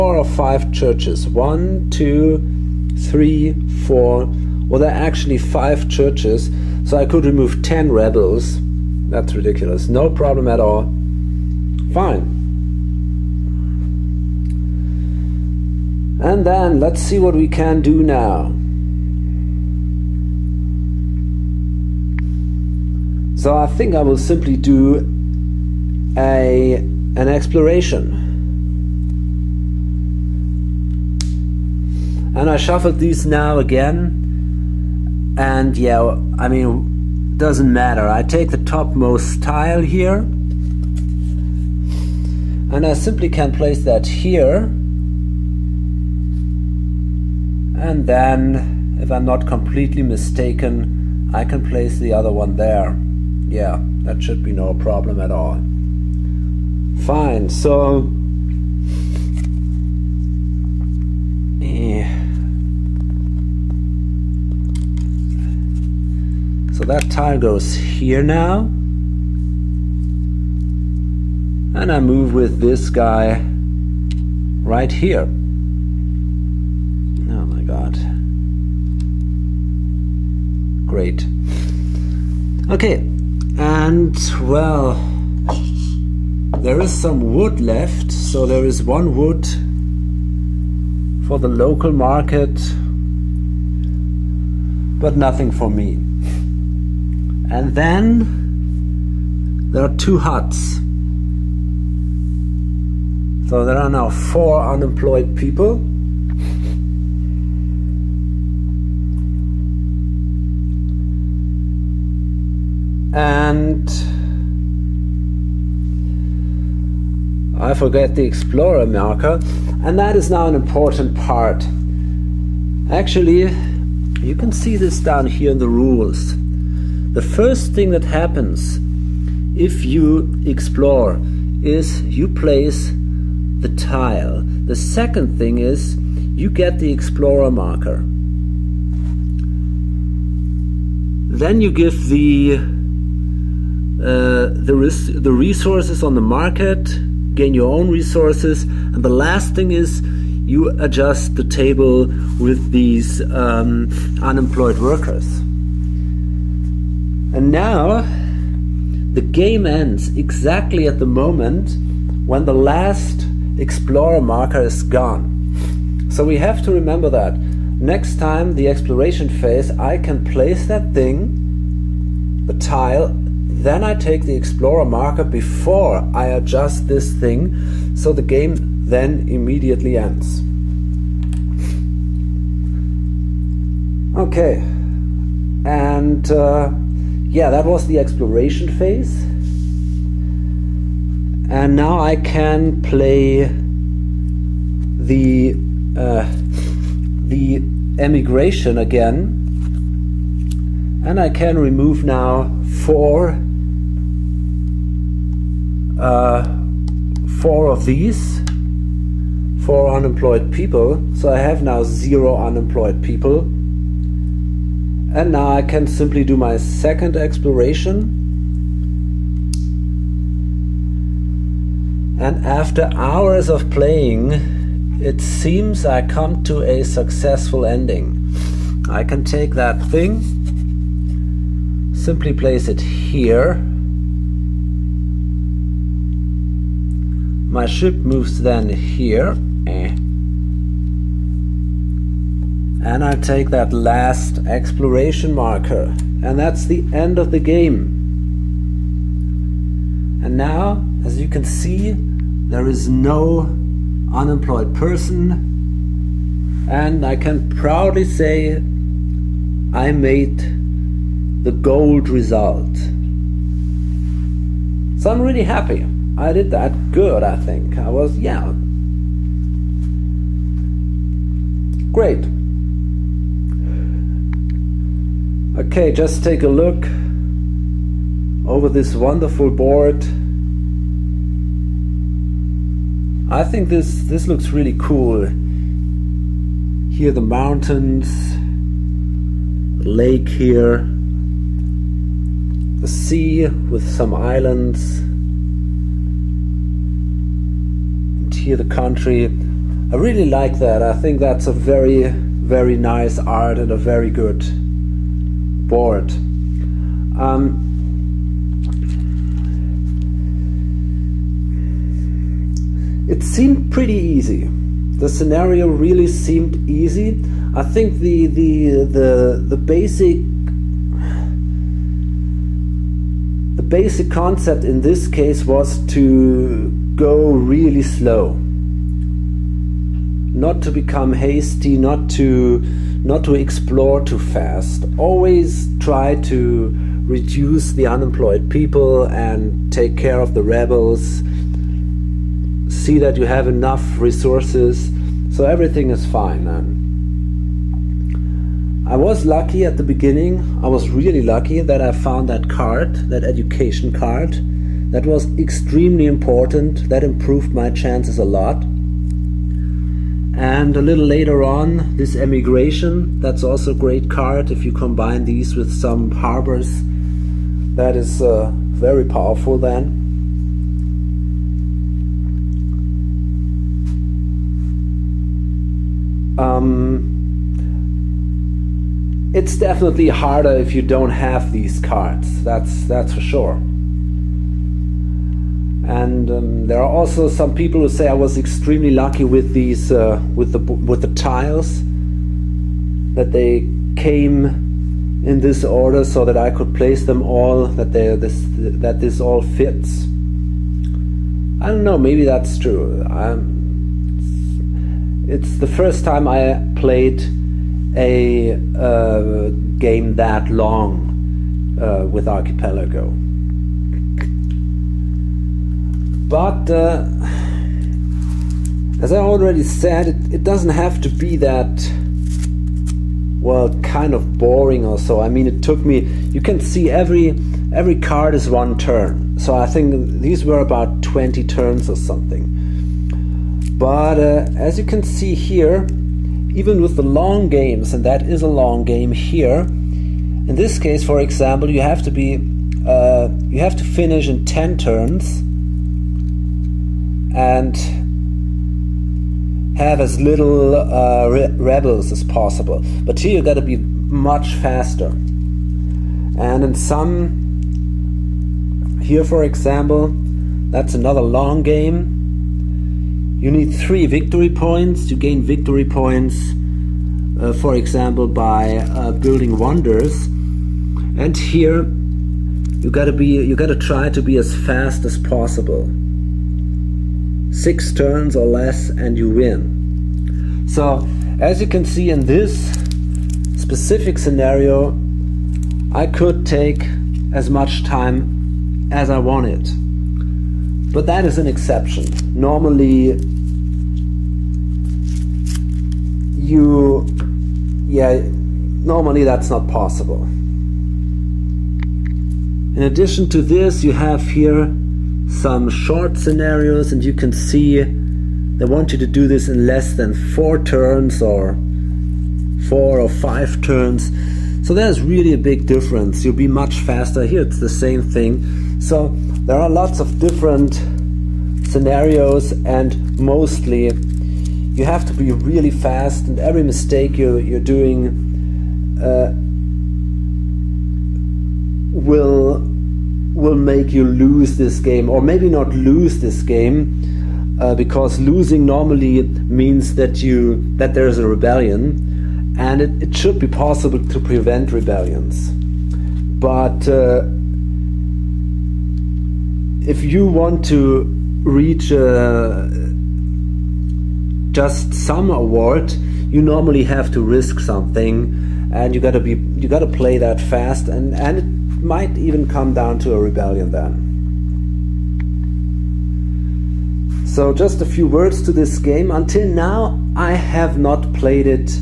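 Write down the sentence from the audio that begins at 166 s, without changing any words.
So we have to remember that.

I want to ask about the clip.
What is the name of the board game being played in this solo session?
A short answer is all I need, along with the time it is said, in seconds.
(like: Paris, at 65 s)
Archipelago, at 412 s.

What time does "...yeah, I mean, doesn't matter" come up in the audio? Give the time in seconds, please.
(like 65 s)
35 s.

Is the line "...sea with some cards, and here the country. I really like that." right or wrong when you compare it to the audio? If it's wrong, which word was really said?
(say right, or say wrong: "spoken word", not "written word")
wrong: "islands", not "cards".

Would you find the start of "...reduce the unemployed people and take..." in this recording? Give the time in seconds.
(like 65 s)
337 s.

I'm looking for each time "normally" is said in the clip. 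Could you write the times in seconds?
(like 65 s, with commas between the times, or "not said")
492 s, 498 s, 538 s, 556 s.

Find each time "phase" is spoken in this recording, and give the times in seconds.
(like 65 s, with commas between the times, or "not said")
169 s, 188 s.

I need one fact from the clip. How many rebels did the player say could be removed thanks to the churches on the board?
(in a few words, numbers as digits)
10.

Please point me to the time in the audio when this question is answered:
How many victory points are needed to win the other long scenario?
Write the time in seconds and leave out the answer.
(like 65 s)
463 s.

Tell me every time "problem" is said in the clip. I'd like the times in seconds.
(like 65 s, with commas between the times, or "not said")
10 s, 54 s.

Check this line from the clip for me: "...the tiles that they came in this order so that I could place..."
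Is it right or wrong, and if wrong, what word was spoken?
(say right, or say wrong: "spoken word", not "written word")
right.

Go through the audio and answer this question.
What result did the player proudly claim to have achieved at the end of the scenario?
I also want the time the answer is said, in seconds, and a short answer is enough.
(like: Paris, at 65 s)
Gold result, at 261 s.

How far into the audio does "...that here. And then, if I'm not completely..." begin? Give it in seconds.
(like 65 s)
43 s.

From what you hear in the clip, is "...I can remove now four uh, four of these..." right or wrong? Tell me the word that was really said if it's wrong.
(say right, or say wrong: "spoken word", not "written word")
right.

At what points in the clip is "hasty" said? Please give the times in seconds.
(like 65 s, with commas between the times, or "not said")
331 s.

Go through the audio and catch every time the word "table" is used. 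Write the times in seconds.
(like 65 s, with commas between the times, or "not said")
151 s.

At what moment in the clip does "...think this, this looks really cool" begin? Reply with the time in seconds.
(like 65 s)
283 s.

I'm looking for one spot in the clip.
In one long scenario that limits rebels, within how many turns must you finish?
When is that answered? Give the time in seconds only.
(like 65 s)
444 s.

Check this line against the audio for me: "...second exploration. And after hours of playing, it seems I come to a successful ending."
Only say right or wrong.
right.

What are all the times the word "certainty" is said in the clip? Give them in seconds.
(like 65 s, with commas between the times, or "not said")
not said.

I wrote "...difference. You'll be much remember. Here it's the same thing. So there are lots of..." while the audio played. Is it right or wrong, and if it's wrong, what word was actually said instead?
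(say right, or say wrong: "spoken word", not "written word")
wrong: "faster", not "remember".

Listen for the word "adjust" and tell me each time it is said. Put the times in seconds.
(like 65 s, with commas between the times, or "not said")
150 s, 176 s.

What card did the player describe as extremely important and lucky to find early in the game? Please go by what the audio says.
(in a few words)
Education card.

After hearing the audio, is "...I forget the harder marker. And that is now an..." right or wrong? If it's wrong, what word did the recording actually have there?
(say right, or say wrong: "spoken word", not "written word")
wrong: "explorer", not "harder".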